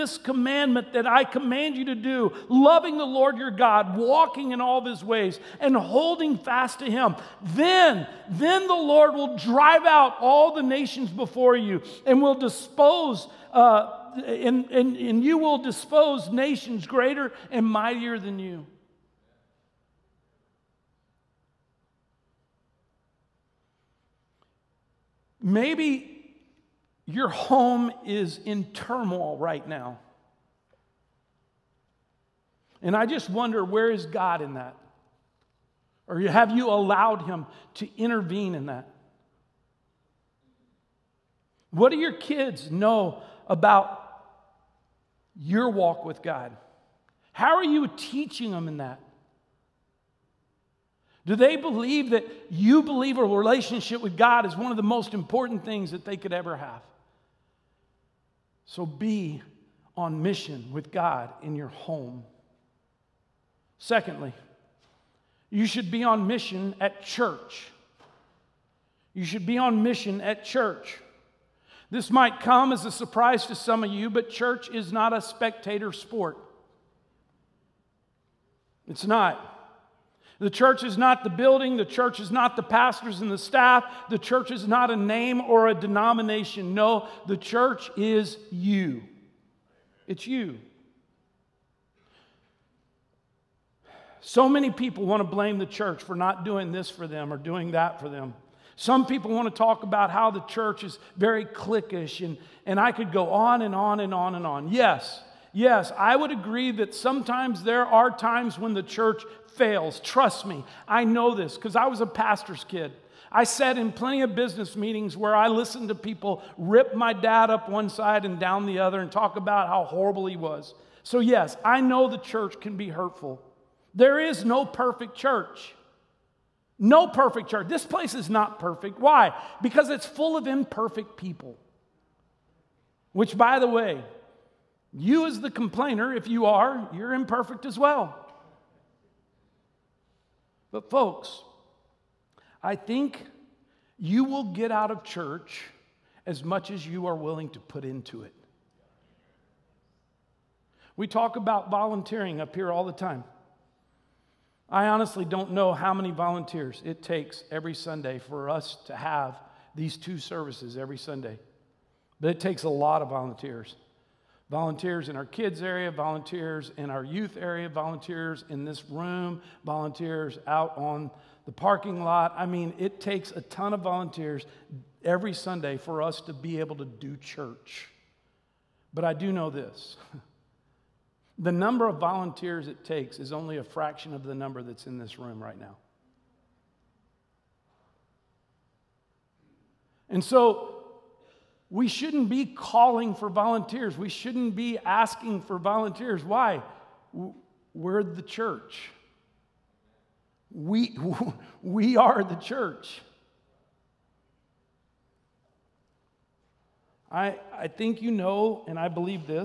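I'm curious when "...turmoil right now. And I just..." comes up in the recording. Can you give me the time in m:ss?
0:28.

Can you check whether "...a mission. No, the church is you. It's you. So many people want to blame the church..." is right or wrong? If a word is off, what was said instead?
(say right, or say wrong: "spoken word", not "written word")
wrong: "denomination", not "mission".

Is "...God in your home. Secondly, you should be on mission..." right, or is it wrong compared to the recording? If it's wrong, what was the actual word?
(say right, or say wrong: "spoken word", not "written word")
right.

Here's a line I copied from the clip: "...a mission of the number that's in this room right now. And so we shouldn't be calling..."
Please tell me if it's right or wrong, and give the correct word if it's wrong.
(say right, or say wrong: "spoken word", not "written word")
wrong: "fraction", not "mission".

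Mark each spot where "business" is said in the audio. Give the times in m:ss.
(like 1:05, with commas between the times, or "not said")
1:54.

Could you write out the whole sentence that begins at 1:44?
Yes, yes, I would agree that sometimes there are times when the church fails.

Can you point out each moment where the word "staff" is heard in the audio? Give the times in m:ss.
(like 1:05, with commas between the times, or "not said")
1:23.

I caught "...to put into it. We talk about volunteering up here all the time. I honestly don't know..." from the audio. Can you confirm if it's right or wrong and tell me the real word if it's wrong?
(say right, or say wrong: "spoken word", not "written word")
right.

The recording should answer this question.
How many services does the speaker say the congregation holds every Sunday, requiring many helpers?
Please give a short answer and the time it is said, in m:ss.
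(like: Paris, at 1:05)
2, at 2:39.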